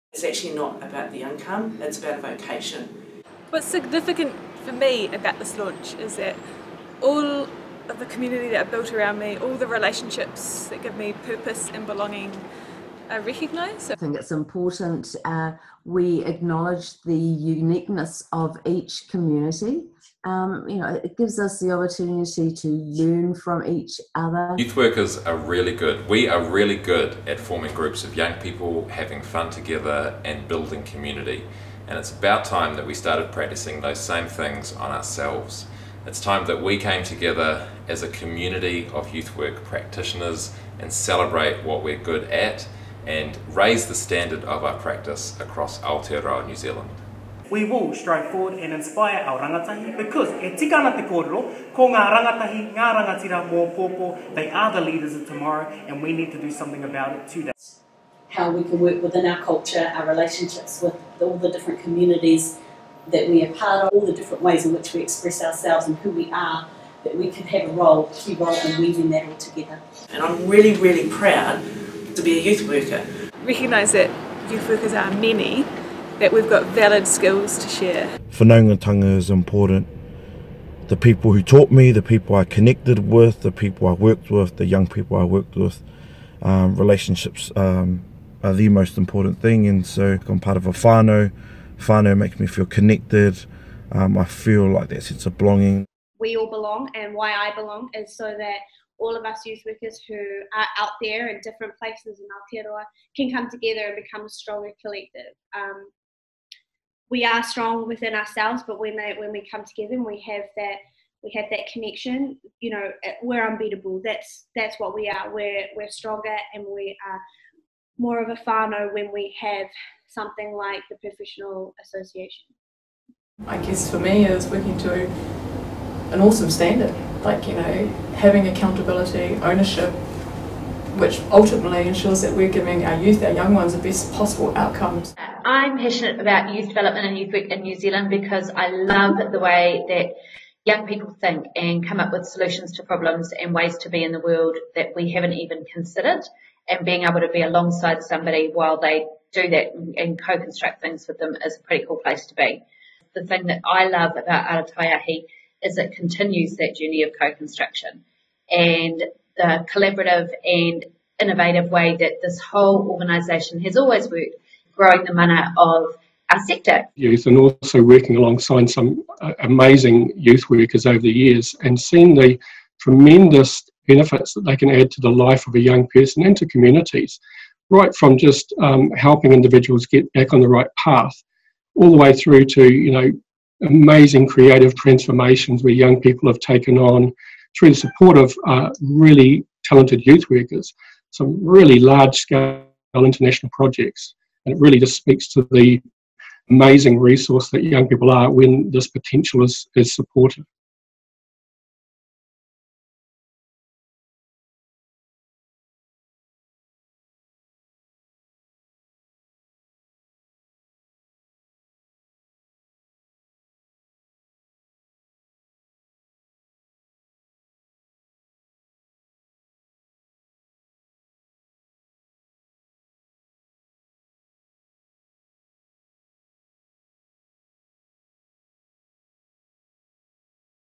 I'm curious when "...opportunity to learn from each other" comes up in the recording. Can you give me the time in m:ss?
0:21.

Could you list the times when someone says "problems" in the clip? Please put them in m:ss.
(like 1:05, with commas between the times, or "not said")
2:22.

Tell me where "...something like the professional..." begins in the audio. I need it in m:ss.
2:00.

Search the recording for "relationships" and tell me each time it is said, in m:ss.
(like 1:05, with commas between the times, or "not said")
0:09, 1:00, 1:26.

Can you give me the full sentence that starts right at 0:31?
And it's about time that we started practicing those same things on ourselves.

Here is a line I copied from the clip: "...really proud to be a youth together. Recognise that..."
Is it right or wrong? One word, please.
wrong.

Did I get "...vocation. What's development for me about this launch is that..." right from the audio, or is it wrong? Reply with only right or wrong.
wrong.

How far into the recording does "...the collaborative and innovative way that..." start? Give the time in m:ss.
2:39.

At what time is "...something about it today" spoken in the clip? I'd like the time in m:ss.
0:56.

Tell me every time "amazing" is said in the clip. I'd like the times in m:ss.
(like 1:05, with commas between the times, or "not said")
2:49, 3:03, 3:16.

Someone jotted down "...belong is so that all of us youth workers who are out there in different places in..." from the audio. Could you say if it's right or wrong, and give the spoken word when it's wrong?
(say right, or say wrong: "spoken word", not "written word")
right.